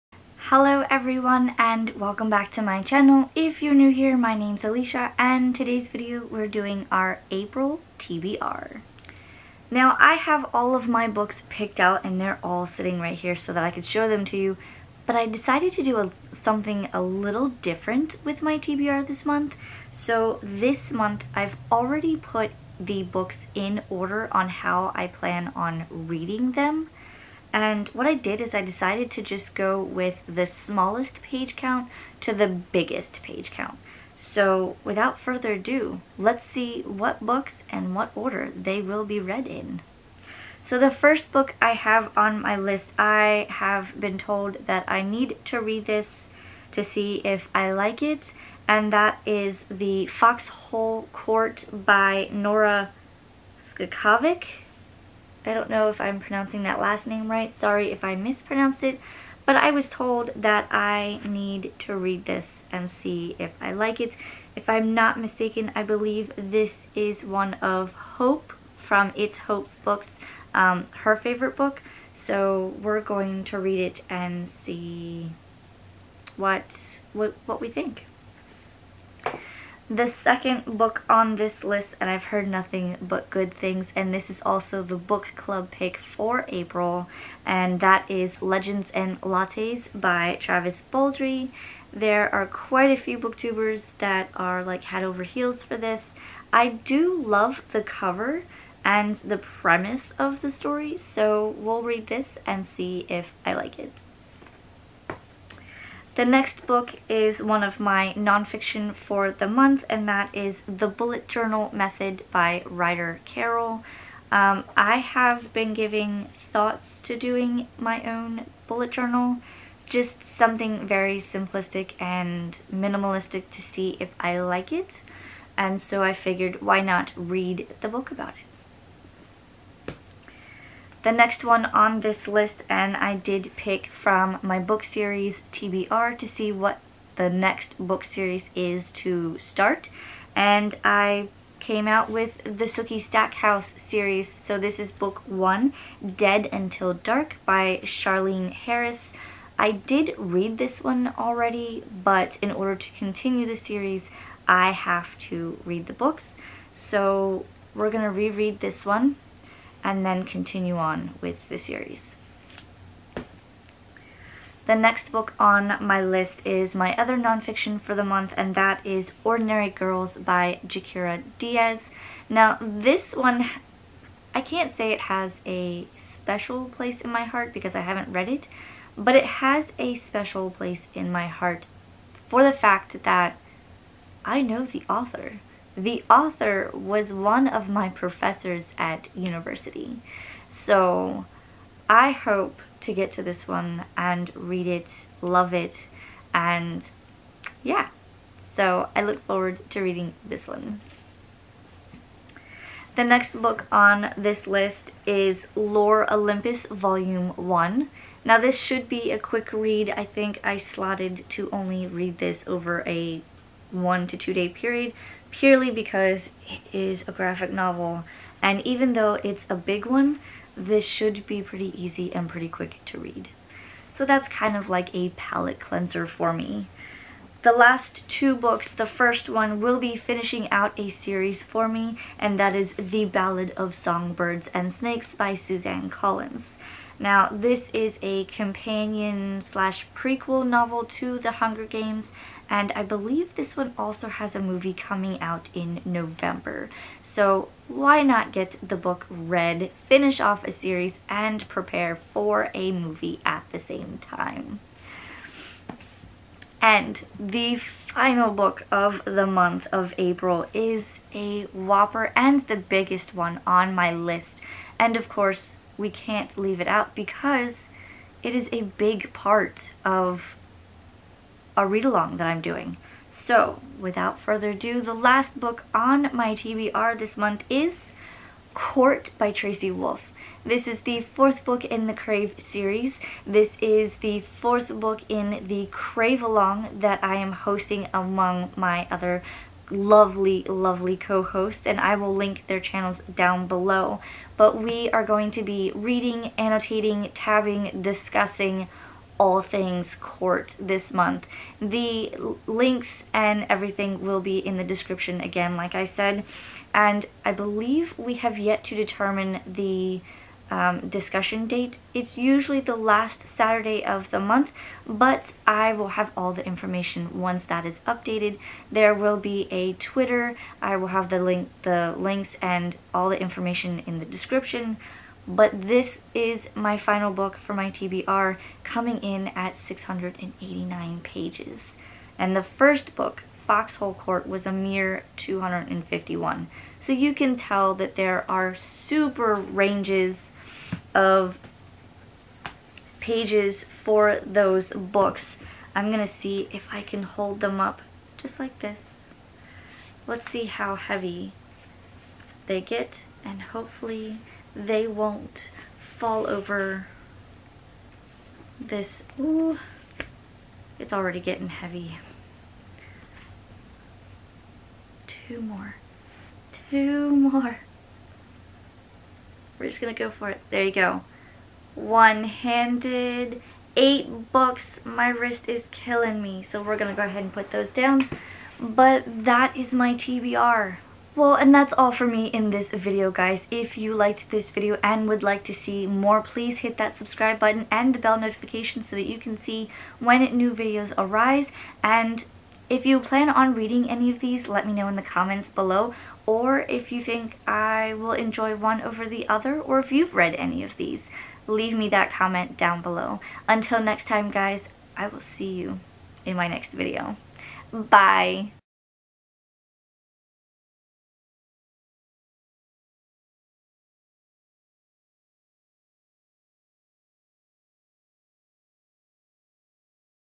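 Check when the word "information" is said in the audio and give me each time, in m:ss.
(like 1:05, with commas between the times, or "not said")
5:16, 5:23.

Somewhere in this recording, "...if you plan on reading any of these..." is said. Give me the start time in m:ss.
6:32.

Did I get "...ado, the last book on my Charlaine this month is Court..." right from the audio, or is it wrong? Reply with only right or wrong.
wrong.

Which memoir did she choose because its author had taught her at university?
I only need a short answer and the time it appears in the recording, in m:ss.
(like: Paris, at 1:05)
Ordinary Girls, at 2:49.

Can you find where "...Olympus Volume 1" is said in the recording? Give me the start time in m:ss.
3:26.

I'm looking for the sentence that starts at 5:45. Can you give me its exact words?
I'm going to see if I can hold them up just like this.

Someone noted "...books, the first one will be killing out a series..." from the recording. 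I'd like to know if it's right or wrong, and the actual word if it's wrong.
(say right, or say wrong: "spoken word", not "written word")
wrong: "finishing", not "killing".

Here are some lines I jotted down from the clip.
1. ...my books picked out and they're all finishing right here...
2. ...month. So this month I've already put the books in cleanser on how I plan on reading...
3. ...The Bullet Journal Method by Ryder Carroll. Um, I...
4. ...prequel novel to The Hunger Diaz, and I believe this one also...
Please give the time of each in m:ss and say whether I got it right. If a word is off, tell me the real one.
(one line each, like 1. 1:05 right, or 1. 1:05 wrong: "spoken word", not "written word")
1. 0:10 wrong: "sitting", not "finishing"
2. 0:19 wrong: "order", not "cleanser"
3. 1:50 right
4. 3:59 wrong: "Games", not "Diaz".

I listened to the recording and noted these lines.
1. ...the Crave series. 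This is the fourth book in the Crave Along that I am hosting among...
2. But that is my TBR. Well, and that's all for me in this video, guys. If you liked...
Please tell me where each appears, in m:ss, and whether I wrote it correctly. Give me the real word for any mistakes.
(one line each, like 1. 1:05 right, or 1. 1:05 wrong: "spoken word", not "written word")
1. 4:41 right
2. 6:18 right.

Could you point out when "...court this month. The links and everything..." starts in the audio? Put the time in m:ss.
4:59.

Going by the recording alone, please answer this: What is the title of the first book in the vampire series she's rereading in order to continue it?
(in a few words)
Dead Until Dark.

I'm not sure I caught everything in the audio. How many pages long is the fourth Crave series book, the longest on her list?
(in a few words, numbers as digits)
689.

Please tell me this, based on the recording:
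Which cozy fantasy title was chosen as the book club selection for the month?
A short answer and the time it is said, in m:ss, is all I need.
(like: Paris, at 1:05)
Legends and Lattes, at 1:28.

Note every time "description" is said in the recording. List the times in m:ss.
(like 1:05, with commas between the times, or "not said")
5:04, 5:24.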